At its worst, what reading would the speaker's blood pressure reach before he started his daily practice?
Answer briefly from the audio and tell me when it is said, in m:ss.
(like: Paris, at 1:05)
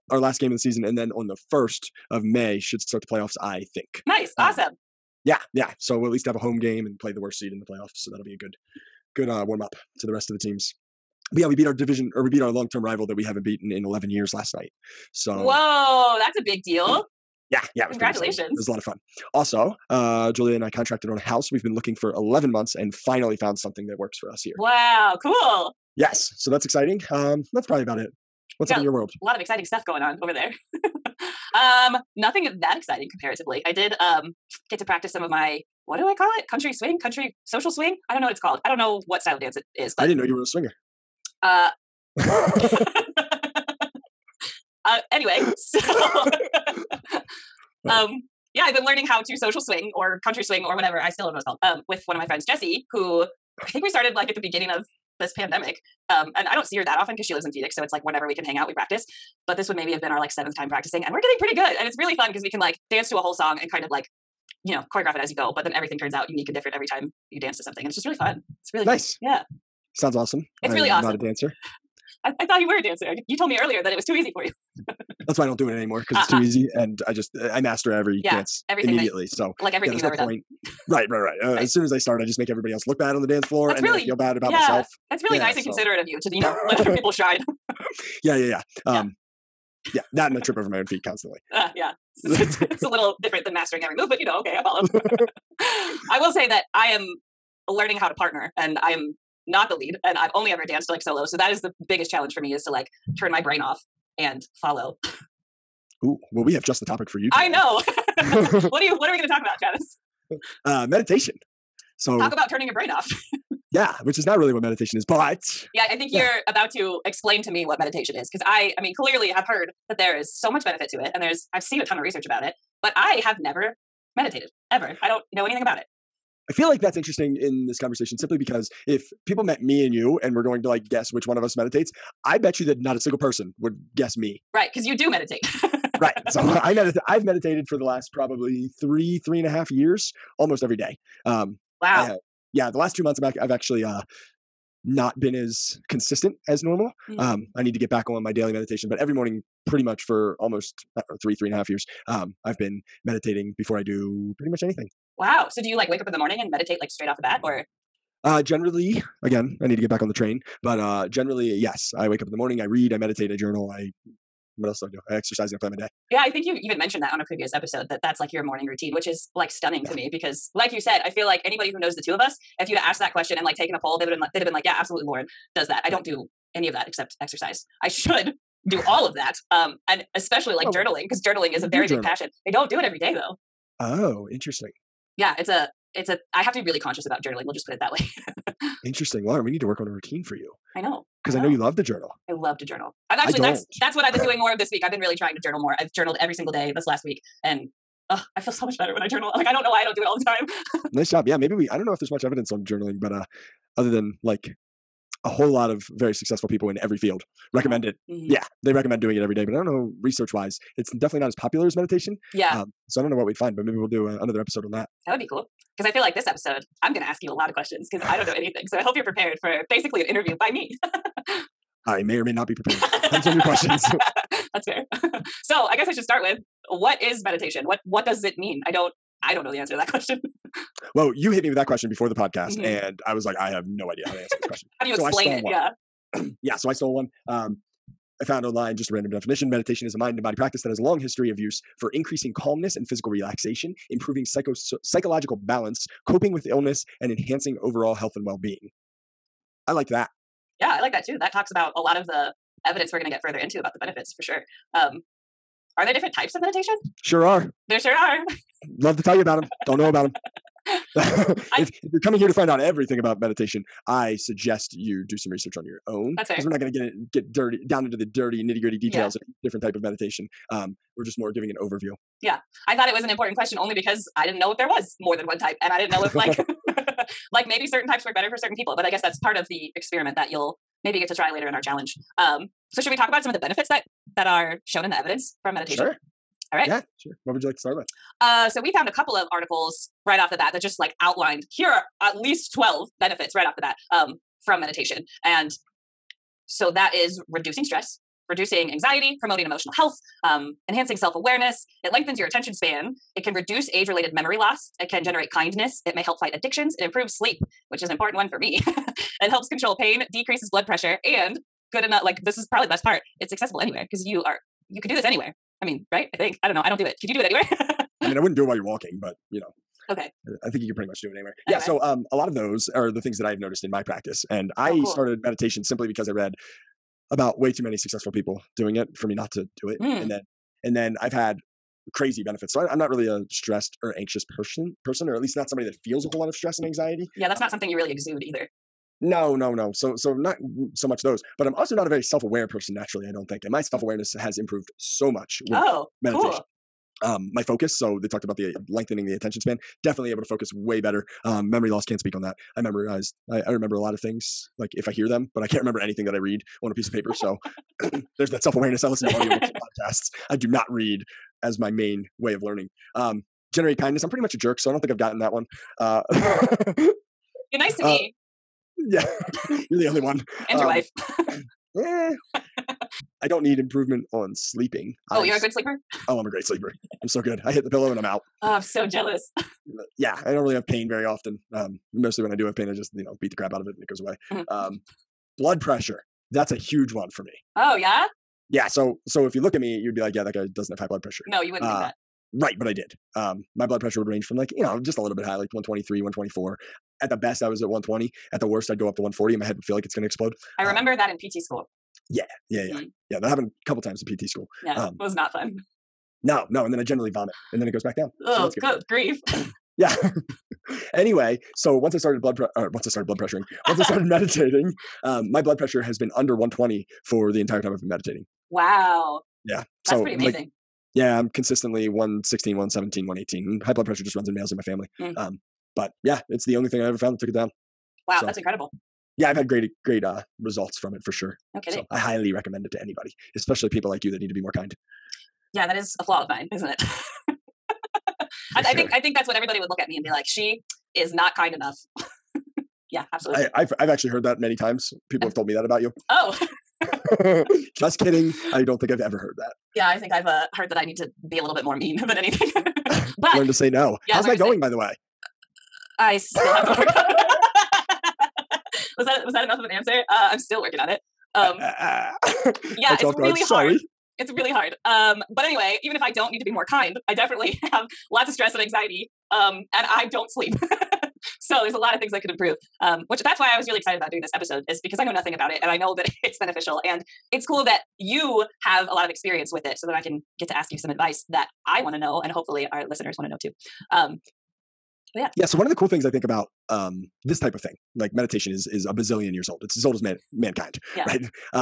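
140, at 6:39.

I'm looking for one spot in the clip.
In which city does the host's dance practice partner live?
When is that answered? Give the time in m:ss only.
0:57.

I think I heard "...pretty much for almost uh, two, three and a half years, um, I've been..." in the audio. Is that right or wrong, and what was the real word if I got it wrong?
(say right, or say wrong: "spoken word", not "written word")
wrong: "three", not "two".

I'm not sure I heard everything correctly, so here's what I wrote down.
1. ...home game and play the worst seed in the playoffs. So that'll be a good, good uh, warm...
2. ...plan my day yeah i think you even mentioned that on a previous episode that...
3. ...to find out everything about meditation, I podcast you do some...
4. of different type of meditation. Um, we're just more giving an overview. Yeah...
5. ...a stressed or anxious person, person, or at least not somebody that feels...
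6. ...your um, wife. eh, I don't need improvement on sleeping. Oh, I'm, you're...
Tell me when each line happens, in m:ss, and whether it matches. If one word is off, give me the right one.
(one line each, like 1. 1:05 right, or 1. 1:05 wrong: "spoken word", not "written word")
1. 0:06 right
2. 2:45 right
3. 4:22 wrong: "suggest", not "podcast"
4. 4:29 right
5. 5:33 right
6. 6:10 right.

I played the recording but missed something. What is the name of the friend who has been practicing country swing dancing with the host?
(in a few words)
Jesse.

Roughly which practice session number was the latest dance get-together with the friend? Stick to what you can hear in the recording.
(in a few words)
seventh.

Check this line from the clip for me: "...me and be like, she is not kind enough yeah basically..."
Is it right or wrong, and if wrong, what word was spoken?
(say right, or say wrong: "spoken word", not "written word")
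wrong: "absolutely", not "basically".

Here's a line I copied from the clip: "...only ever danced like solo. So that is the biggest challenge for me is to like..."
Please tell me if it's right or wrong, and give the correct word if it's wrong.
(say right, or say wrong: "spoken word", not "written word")
right.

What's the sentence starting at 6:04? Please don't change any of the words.
I'm pretty much a jerk, so I don't think I've gotten that one.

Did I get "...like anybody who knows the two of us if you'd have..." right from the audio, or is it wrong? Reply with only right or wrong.
right.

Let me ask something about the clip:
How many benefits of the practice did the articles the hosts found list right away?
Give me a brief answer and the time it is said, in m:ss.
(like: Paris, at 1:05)
12, at 4:52.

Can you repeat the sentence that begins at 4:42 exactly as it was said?
Um, so, should we talk about some of the benefits that that are shown in the evidence from meditation?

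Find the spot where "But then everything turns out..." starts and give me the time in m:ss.
1:05.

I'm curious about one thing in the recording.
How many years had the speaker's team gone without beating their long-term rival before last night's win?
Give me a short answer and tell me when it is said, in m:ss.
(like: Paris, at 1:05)
11 years, at 0:13.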